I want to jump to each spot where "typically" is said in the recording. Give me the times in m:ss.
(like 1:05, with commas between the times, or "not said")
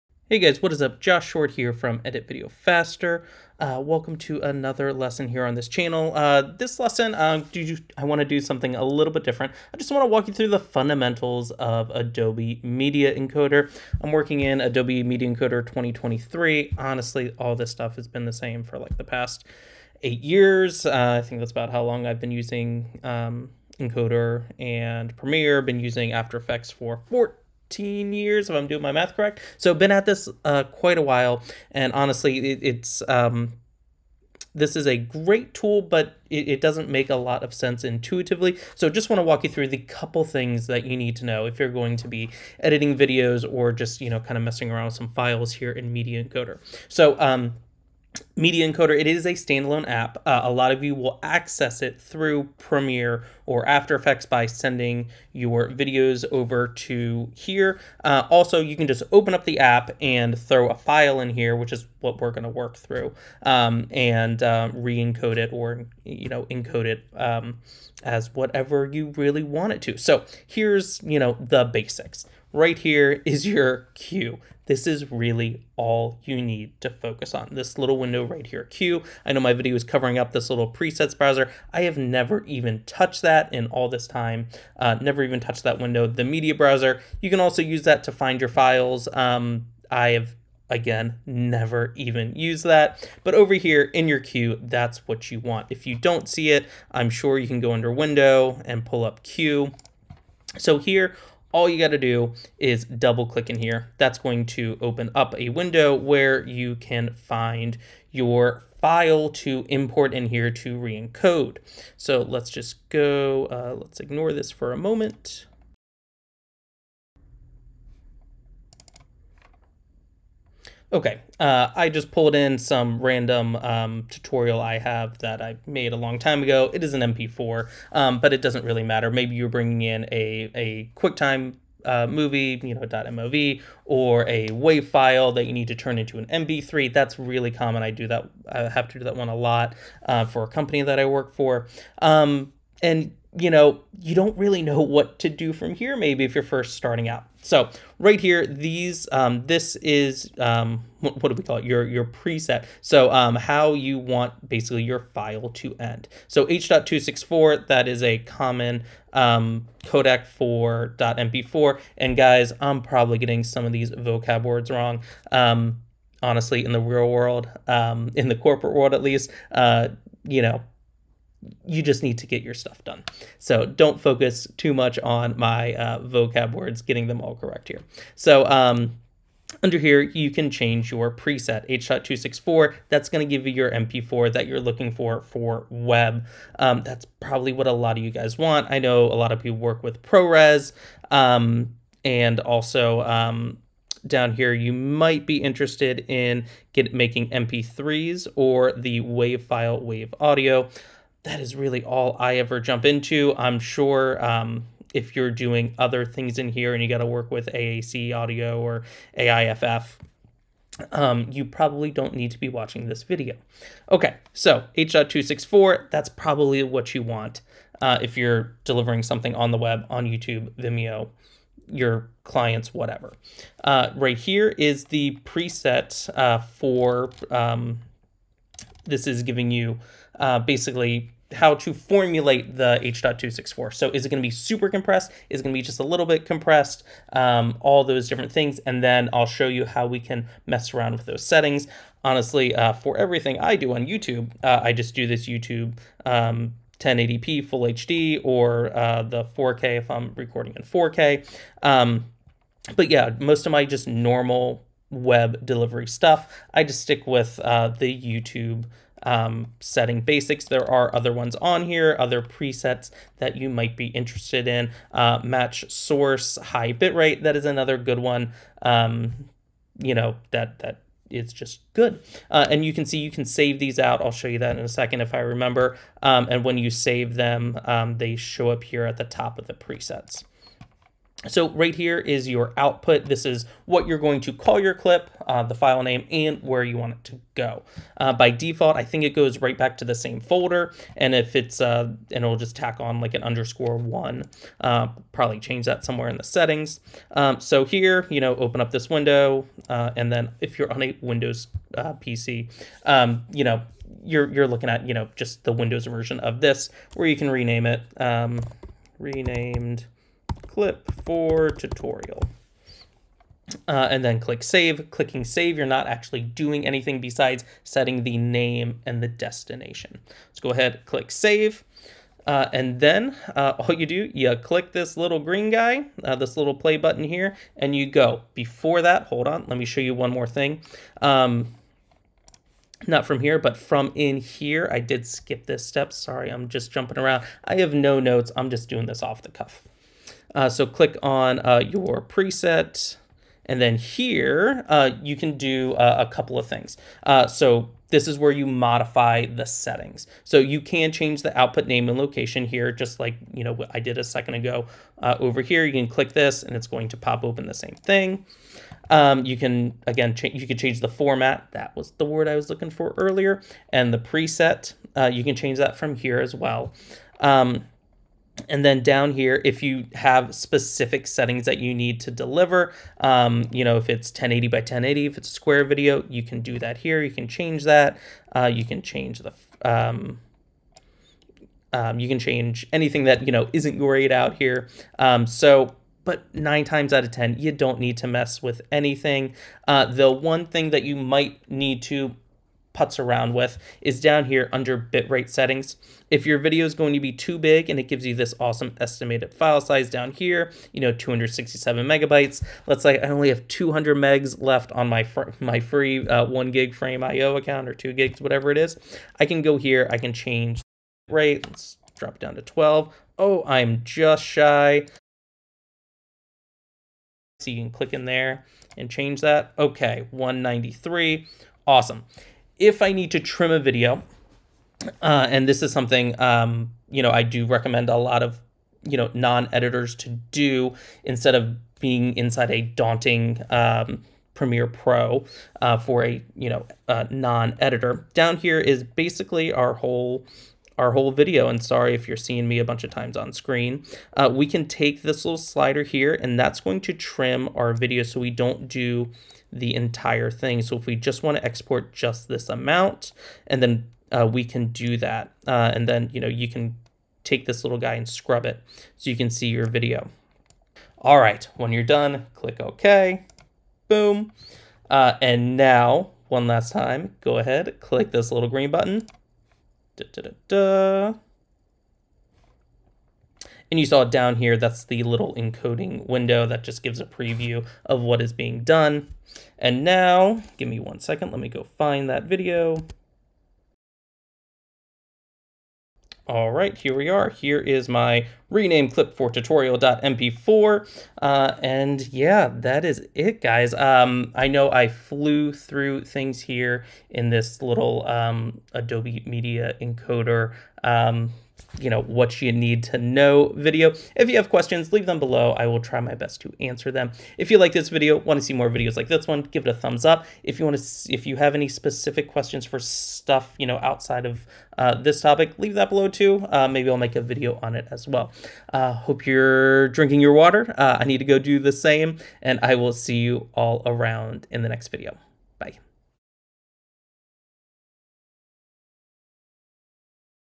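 not said.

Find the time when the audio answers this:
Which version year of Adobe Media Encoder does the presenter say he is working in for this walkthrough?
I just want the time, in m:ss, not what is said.
0:14.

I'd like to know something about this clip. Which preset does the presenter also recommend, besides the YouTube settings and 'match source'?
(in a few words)
High bitrate.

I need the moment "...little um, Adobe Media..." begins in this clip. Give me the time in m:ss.
8:17.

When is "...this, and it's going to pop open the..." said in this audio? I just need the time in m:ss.
5:56.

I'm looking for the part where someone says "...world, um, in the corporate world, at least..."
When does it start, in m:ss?
2:47.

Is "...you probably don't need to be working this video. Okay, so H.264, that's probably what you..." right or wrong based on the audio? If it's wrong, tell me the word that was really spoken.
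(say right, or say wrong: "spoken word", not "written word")
wrong: "watching", not "working".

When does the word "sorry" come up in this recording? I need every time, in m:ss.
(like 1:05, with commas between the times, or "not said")
5:35, 7:21.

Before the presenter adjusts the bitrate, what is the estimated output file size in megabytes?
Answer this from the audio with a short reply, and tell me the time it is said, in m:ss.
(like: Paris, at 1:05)
267 megabytes, at 6:40.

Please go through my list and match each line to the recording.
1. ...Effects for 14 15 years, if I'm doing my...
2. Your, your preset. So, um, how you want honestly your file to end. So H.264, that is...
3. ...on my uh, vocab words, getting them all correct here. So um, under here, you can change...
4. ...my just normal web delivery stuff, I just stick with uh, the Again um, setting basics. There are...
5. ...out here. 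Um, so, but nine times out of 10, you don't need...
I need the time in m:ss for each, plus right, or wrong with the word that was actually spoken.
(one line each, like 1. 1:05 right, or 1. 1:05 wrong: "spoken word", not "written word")
1. 0:26 right
2. 2:31 wrong: "basically", not "honestly"
3. 2:54 right
4. 4:13 wrong: "YouTube", not "Again"
5. 6:24 right.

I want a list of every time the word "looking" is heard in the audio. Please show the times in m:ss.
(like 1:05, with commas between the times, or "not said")
3:04, 5:04, 6:02.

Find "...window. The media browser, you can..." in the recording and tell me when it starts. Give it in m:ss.
1:25.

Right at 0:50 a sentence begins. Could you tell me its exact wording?
Uh, a lot of you will access it through Premiere or After Effects by sending your videos over to here.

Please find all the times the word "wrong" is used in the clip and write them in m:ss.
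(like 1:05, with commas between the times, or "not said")
2:44.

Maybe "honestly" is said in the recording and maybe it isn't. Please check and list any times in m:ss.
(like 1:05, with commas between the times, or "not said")
0:16, 0:31, 2:46, 4:02.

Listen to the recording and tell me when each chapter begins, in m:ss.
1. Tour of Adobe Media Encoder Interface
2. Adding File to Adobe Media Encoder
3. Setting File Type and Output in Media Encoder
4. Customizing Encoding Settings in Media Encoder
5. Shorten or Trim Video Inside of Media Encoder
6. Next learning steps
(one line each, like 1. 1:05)
1. 1:12
2. 1:40
3. 2:27
4. 5:40
5. 7:02
6. 8:12.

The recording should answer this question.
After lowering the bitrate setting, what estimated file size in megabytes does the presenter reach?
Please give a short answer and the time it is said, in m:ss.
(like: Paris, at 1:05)
193, at 7:00.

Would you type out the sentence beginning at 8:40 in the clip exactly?
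Uh, I need to go do the same and I will see you all around in the next video.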